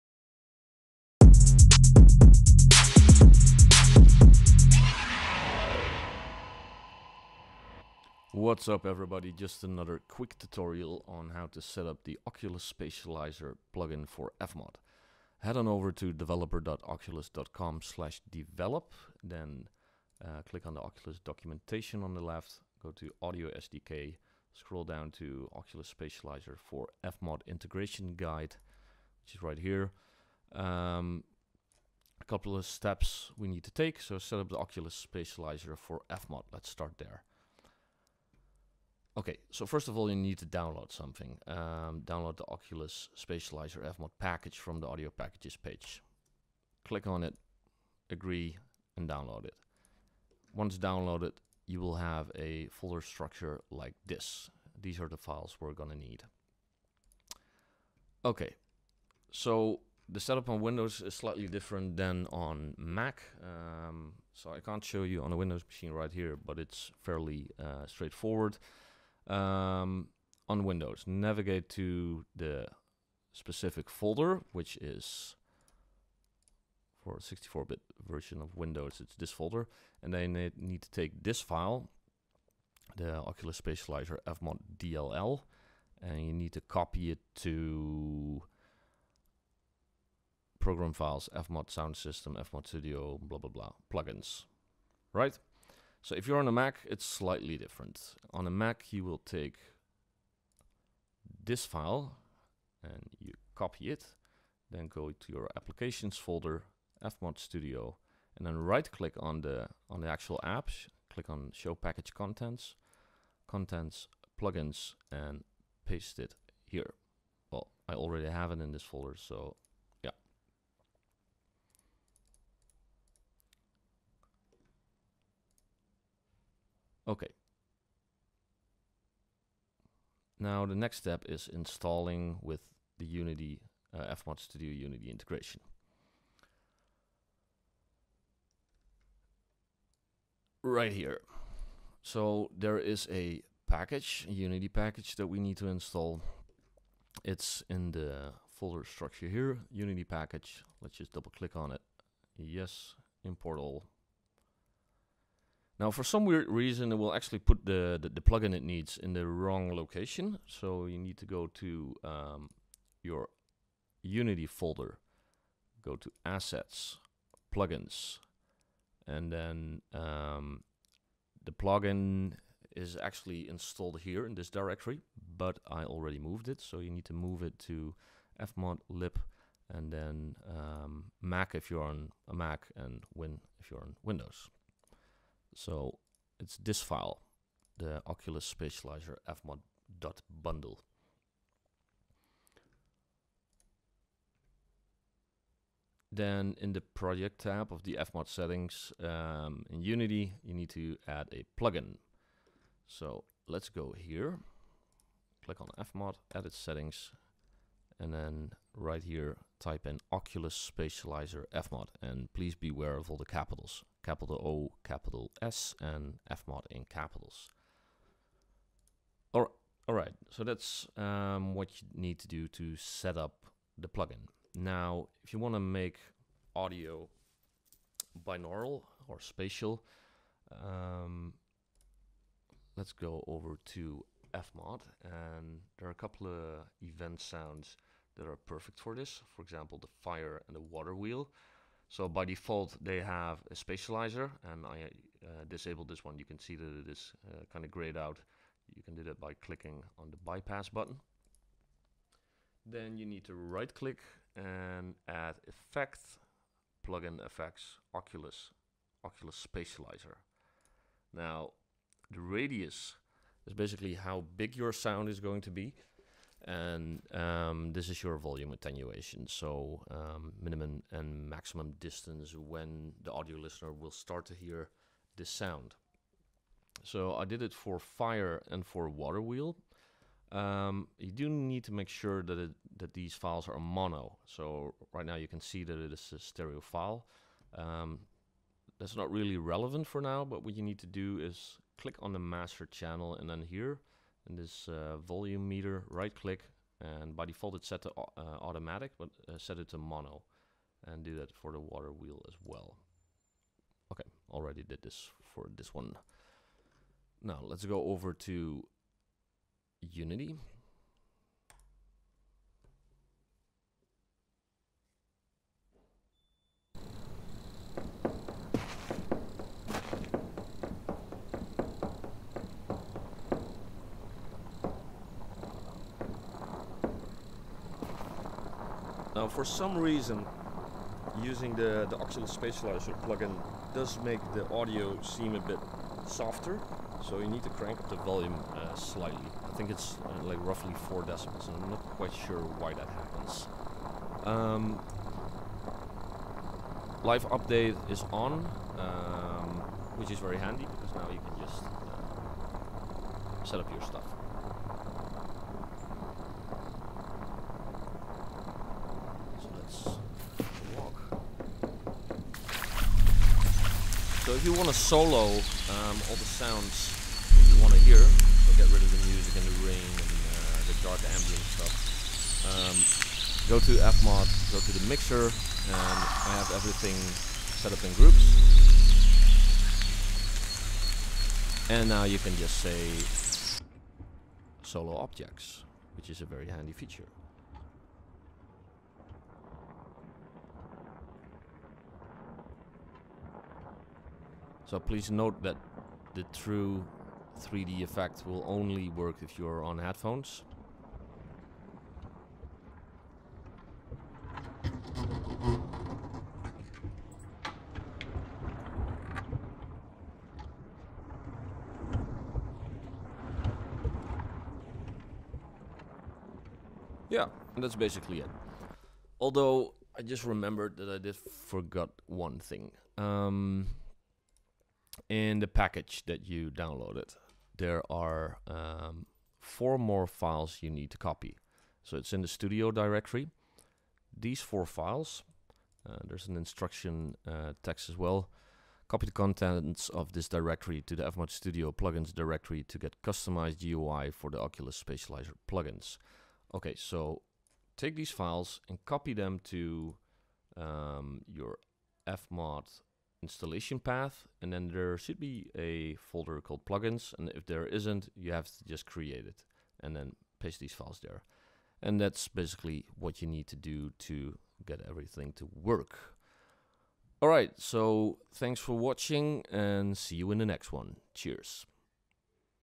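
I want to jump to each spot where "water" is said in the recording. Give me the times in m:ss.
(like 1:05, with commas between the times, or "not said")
4:00, 4:38, 5:01.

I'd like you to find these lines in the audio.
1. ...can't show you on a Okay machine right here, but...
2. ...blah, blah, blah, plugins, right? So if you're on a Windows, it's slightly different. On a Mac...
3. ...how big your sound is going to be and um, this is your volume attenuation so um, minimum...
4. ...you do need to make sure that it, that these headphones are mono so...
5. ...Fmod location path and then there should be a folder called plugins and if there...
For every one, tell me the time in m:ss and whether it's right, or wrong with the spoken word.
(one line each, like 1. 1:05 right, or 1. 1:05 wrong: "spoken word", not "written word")
1. 1:04 wrong: "Windows", not "Okay"
2. 1:33 wrong: "Mac", not "Windows"
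3. 4:23 right
4. 4:40 wrong: "files", not "headphones"
5. 7:32 wrong: "installation", not "location".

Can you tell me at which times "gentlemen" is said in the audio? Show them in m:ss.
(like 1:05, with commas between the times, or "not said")
not said.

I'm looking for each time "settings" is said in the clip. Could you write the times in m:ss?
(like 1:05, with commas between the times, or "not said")
3:18, 3:26.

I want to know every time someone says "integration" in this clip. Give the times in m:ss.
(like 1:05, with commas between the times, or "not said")
0:27, 2:15.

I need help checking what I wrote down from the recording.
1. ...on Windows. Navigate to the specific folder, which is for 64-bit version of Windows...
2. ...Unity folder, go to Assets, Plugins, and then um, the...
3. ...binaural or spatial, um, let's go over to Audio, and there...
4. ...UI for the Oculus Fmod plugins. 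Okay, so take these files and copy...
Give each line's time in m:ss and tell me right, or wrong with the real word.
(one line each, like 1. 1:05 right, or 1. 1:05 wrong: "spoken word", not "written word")
1. 1:10 right
2. 2:44 right
3. 3:48 wrong: "FMOD", not "Audio"
4. 7:23 wrong: "Spatializer", not "Fmod".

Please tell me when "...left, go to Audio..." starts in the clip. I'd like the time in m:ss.
0:22.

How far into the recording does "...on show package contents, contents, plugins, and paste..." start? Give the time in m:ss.
1:51.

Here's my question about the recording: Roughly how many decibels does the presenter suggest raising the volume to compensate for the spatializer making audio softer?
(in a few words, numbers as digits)
4 decibels.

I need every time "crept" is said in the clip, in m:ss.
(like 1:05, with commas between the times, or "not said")
not said.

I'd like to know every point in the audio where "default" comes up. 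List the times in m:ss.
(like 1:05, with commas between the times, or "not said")
4:02, 4:57.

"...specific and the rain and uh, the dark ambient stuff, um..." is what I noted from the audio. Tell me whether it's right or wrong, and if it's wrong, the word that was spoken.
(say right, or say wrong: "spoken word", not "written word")
wrong: "music", not "specific".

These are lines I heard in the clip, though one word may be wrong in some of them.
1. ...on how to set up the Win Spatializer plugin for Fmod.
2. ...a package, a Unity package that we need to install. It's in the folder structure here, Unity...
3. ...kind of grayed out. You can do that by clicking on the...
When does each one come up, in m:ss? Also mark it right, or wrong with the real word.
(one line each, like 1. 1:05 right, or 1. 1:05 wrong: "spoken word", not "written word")
1. 0:11 wrong: "Oculus", not "Win"
2. 2:23 right
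3. 4:07 right.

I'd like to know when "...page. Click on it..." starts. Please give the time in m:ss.
0:45.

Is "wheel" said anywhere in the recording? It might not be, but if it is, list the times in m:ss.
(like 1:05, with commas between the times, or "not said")
4:00, 4:39, 5:01.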